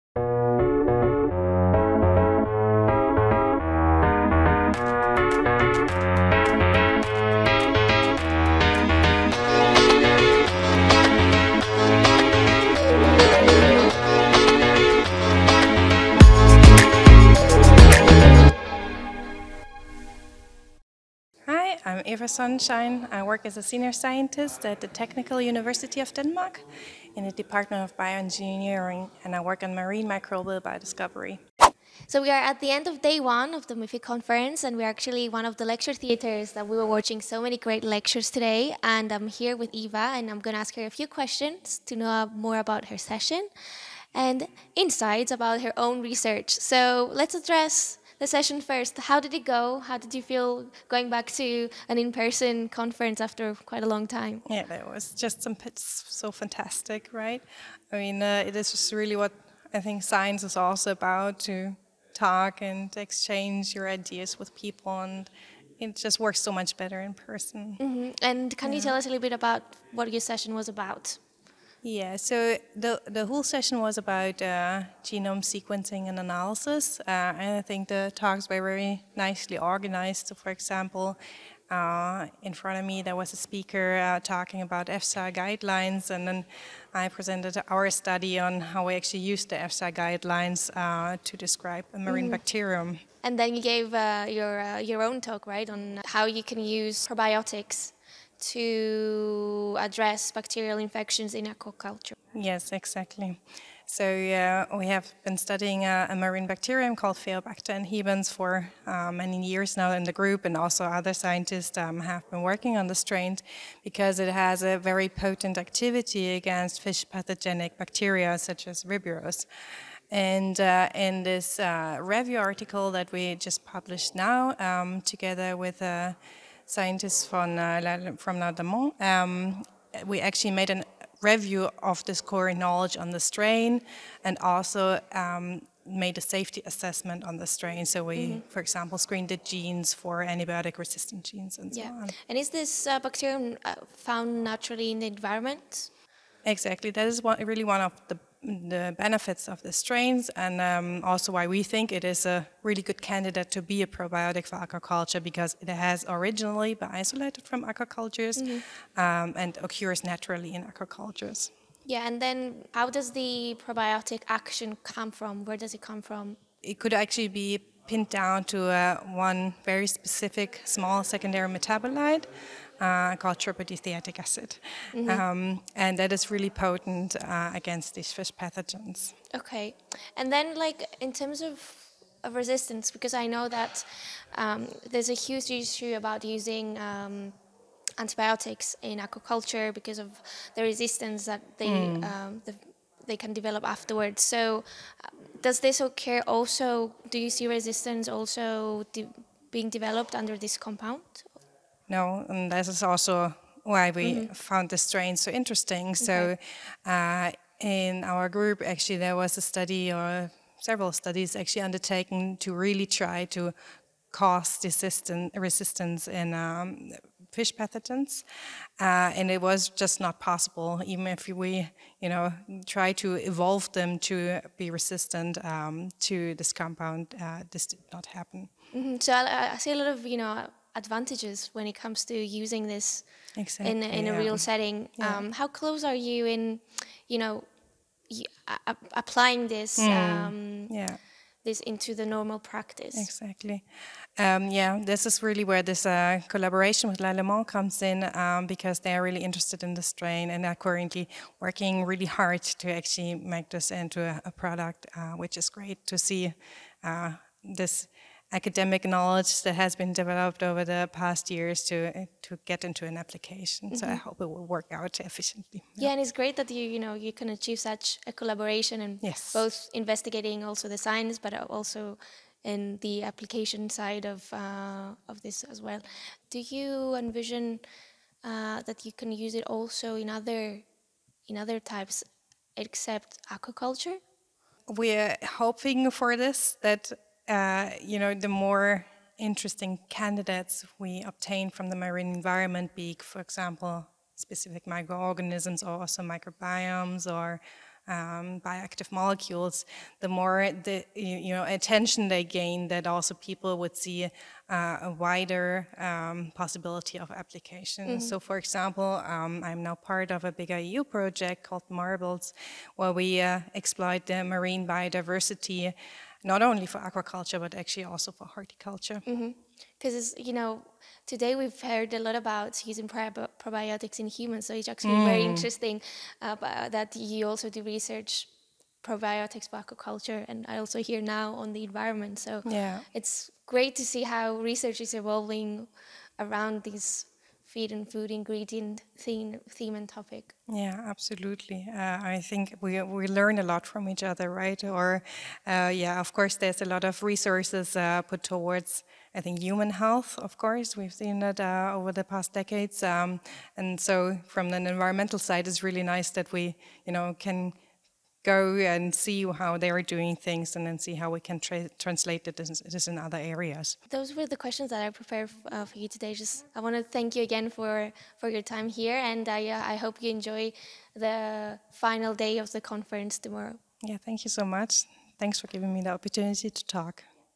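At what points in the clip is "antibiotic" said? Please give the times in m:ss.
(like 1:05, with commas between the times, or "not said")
2:20, 3:07.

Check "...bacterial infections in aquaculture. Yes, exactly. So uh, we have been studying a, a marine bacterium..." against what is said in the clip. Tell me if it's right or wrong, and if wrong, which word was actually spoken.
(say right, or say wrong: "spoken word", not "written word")
right.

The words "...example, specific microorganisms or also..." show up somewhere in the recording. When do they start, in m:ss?
4:53.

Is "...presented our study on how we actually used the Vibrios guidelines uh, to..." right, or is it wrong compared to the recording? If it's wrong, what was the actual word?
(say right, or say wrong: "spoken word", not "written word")
wrong: "EFSA", not "Vibrios".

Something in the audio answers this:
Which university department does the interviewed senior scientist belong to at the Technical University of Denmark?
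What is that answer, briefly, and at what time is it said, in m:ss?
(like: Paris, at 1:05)
Department of Bioengineering, at 0:27.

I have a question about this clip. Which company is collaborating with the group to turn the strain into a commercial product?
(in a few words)
Lallemand.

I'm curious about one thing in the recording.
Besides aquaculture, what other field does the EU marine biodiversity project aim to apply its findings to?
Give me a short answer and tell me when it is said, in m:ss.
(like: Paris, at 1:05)
horticulture, at 5:18.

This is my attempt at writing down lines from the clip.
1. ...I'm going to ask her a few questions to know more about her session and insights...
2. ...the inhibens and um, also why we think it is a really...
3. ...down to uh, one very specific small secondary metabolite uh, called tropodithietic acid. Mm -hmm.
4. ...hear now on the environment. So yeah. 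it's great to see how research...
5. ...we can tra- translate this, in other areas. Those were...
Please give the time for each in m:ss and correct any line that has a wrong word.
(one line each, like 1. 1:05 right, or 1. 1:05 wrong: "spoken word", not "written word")
1. 0:40 right
2. 2:29 wrong: "strains", not "inhibens"
3. 2:48 right
4. 5:30 right
5. 6:01 right.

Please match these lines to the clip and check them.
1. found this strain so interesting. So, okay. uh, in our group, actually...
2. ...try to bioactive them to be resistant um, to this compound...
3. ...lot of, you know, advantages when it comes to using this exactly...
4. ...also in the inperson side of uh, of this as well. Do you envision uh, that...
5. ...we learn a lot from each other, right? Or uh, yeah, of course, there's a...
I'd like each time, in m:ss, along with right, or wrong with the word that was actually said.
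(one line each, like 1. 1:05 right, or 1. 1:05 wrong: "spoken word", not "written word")
1. 3:24 right
2. 3:42 wrong: "evolve", not "bioactive"
3. 3:49 right
4. 4:31 wrong: "application", not "inperson"
5. 5:42 right.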